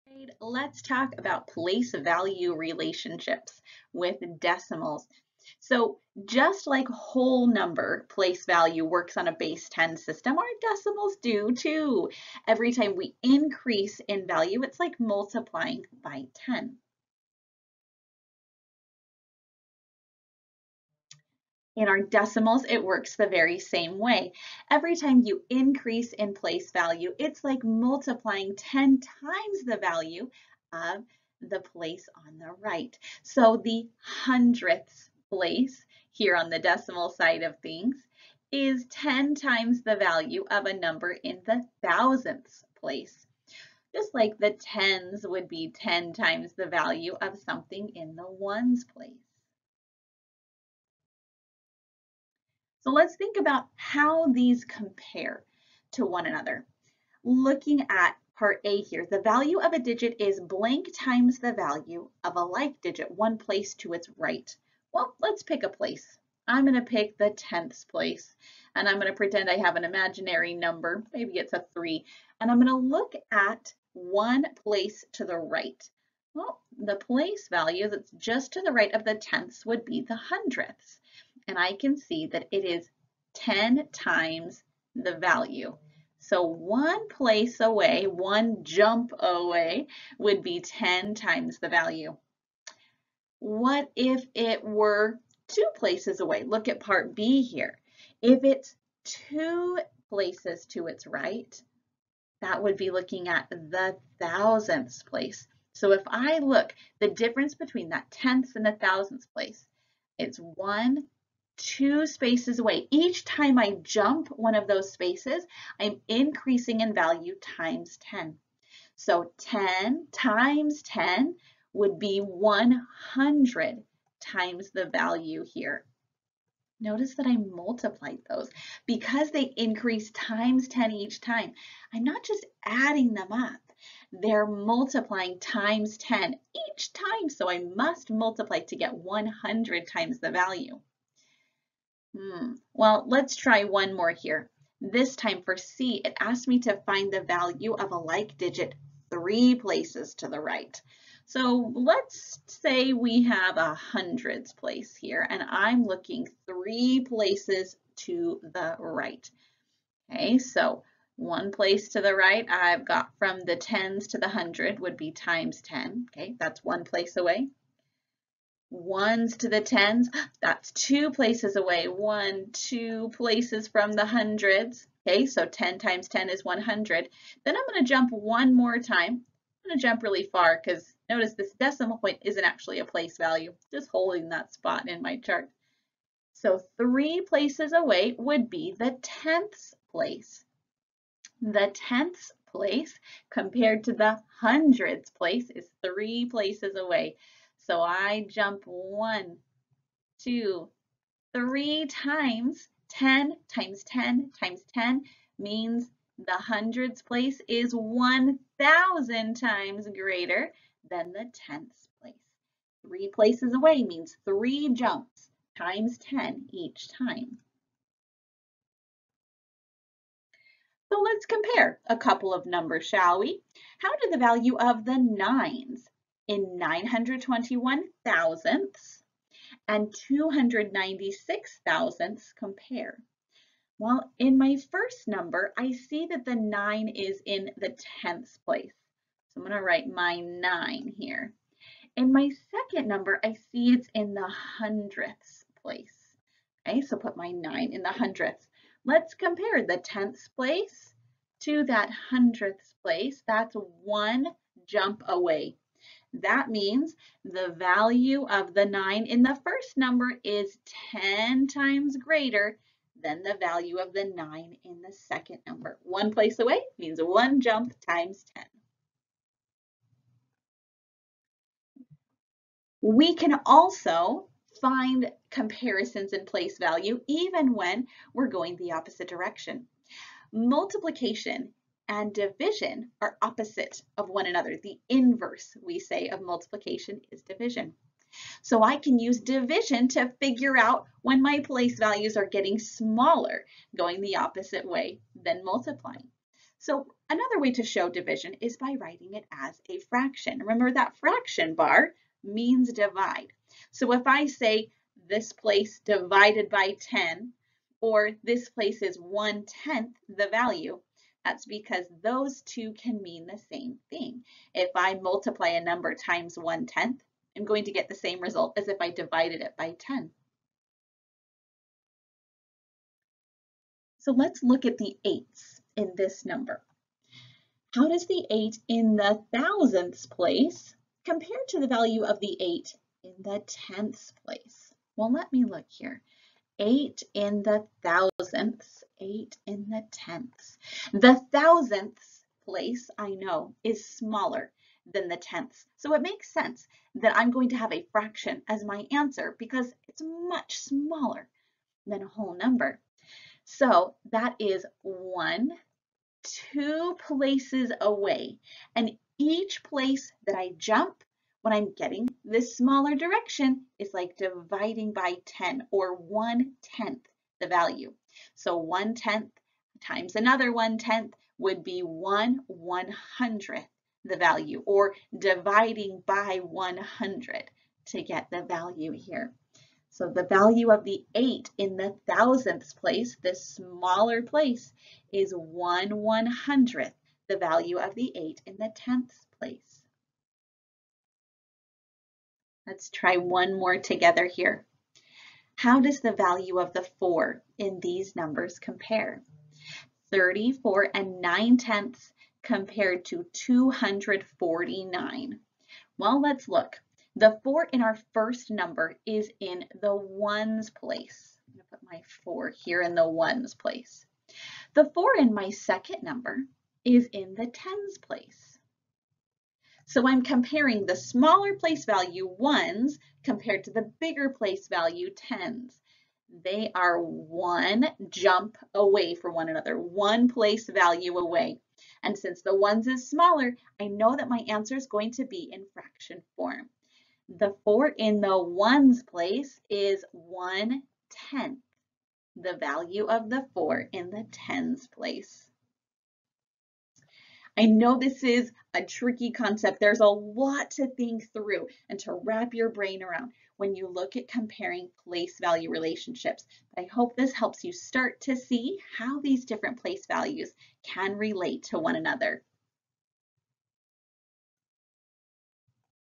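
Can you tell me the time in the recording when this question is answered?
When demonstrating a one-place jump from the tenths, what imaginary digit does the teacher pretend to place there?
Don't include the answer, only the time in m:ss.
1:11.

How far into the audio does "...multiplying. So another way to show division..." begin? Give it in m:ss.
4:55.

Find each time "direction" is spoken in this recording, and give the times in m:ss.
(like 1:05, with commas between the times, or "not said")
4:39, 6:02.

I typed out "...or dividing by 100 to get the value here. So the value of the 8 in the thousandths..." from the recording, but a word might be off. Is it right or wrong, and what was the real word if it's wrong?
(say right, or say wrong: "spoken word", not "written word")
right.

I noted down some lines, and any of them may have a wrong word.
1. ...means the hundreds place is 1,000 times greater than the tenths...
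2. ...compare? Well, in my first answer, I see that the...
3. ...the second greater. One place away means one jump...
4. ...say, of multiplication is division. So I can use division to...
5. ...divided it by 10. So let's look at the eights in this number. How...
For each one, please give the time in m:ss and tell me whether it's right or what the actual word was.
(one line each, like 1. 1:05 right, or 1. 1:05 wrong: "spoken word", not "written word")
1. 3:25 right
2. 3:52 wrong: "number", not "answer"
3. 4:24 wrong: "number", not "greater"
4. 4:45 right
5. 5:18 right.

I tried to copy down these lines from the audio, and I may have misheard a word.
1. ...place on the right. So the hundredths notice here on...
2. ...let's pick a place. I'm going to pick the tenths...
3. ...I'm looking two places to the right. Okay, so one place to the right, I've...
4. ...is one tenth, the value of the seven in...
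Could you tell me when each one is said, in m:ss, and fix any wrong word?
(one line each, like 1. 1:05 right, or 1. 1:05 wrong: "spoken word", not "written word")
1. 0:31 wrong: "place", not "notice"
2. 1:05 right
3. 2:35 wrong: "three", not "two"
4. 7:19 wrong: "four", not "seven".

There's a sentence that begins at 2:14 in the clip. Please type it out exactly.
They're multiplying times 10 each time, so I must multiply to get 100 times the value.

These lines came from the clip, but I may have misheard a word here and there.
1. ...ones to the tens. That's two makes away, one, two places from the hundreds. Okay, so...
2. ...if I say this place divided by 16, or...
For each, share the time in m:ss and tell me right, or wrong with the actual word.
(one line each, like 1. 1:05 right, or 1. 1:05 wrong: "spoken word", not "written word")
1. 2:48 wrong: "places", not "makes"
2. 5:03 wrong: "10", not "16".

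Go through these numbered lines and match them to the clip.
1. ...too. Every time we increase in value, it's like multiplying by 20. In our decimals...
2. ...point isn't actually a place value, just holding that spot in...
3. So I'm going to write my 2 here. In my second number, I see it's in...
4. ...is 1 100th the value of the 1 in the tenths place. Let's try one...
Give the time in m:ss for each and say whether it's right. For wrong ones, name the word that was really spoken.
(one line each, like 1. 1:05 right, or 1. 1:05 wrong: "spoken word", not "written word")
1. 0:11 wrong: "10", not "20"
2. 3:01 right
3. 3:59 wrong: "9", not "2"
4. 6:25 wrong: "8", not "1".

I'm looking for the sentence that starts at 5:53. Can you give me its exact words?
So that is one, two places away.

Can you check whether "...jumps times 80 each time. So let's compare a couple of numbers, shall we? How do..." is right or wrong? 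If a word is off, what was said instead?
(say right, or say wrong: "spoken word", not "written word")
wrong: "10", not "80".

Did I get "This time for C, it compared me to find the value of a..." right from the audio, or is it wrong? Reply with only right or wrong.
wrong.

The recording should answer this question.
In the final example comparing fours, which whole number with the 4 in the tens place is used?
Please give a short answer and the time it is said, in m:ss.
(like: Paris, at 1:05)
249, at 6:43.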